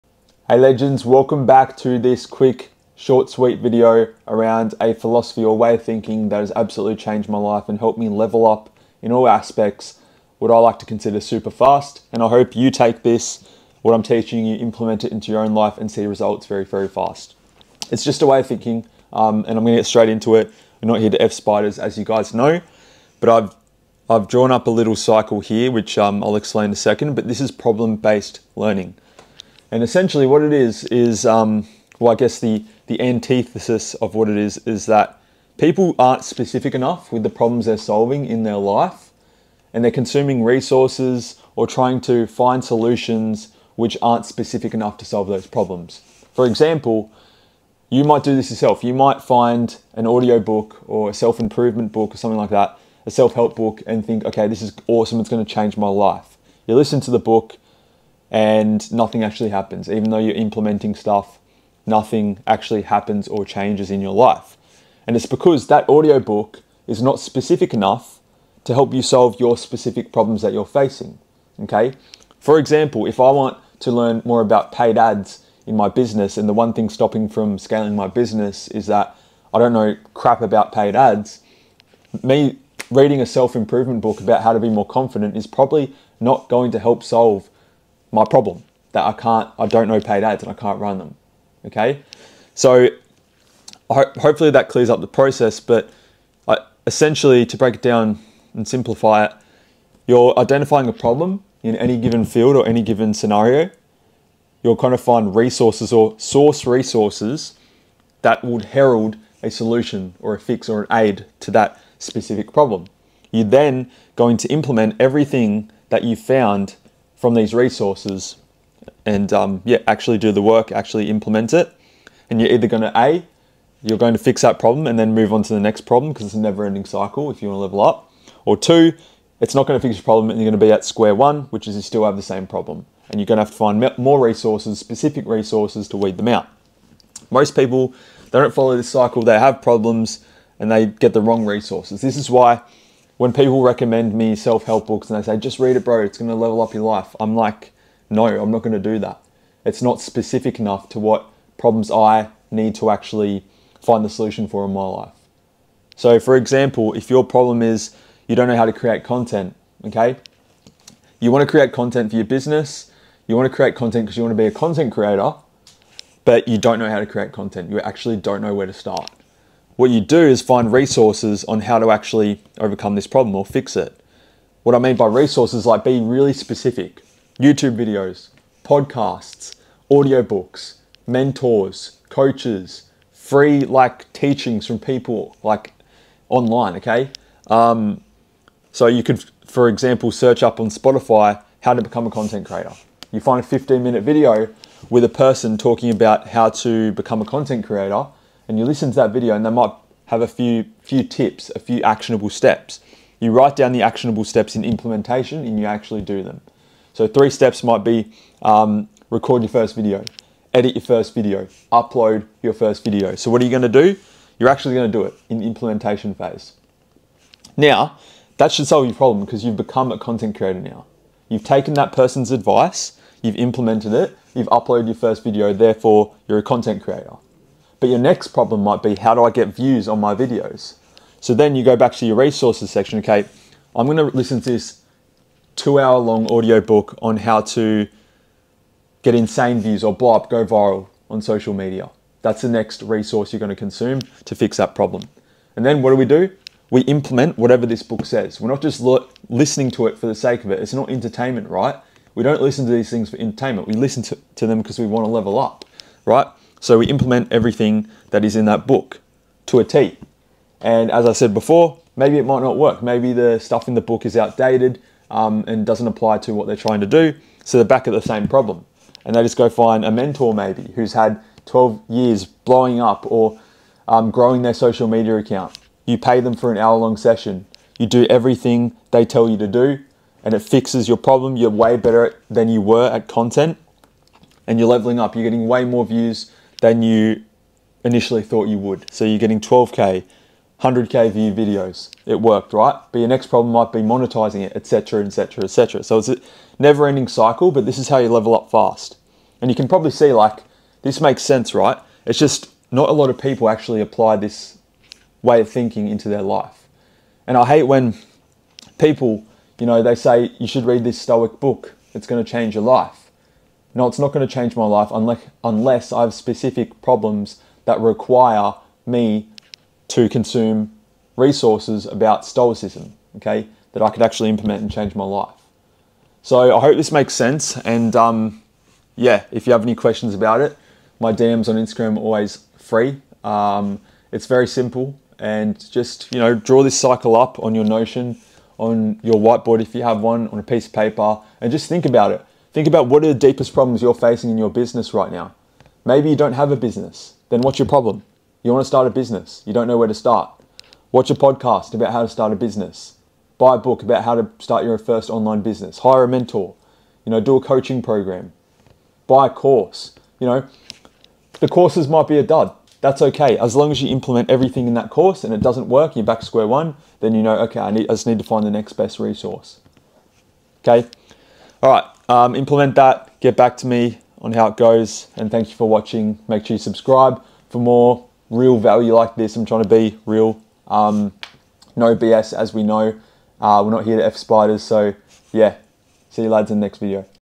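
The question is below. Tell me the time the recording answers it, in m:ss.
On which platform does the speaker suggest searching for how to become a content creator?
3:10.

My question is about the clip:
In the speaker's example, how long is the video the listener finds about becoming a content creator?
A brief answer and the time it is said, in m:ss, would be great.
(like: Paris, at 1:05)
15 minutes, at 3:13.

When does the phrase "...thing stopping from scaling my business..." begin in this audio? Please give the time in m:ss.
1:16.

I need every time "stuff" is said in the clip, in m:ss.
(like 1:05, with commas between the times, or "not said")
1:00, 4:23.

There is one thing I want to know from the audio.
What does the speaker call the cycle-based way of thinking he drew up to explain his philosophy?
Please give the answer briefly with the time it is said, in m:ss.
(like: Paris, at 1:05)
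Problem-based learning, at 0:27.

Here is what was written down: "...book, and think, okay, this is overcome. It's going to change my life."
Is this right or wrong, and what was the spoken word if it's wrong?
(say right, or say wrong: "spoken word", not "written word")
wrong: "awesome", not "overcome".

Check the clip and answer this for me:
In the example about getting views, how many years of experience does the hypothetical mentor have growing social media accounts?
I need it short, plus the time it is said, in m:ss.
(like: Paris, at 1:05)
12 years, at 4:31.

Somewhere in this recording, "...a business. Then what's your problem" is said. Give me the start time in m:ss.
5:46.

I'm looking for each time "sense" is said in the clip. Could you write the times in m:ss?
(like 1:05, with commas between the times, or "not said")
5:01, 5:27.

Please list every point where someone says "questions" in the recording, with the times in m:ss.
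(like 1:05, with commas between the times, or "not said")
5:29.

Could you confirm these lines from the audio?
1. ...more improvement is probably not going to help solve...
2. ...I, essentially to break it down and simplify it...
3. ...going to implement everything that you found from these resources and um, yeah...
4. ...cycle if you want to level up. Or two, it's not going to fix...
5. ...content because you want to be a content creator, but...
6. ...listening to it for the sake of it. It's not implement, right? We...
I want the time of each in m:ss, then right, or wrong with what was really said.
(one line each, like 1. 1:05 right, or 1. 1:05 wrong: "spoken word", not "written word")
1. 1:24 wrong: "confident", not "improvement"
2. 1:36 right
3. 1:54 right
4. 2:06 right
5. 2:43 right
6. 4:09 wrong: "entertainment", not "implement".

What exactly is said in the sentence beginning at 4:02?
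That's the next resource you're going to consume to fix that problem.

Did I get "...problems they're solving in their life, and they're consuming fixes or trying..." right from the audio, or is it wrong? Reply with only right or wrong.
wrong.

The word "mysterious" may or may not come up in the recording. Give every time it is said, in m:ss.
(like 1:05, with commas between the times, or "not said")
not said.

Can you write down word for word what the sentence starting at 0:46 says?
For example, you might do this yourself.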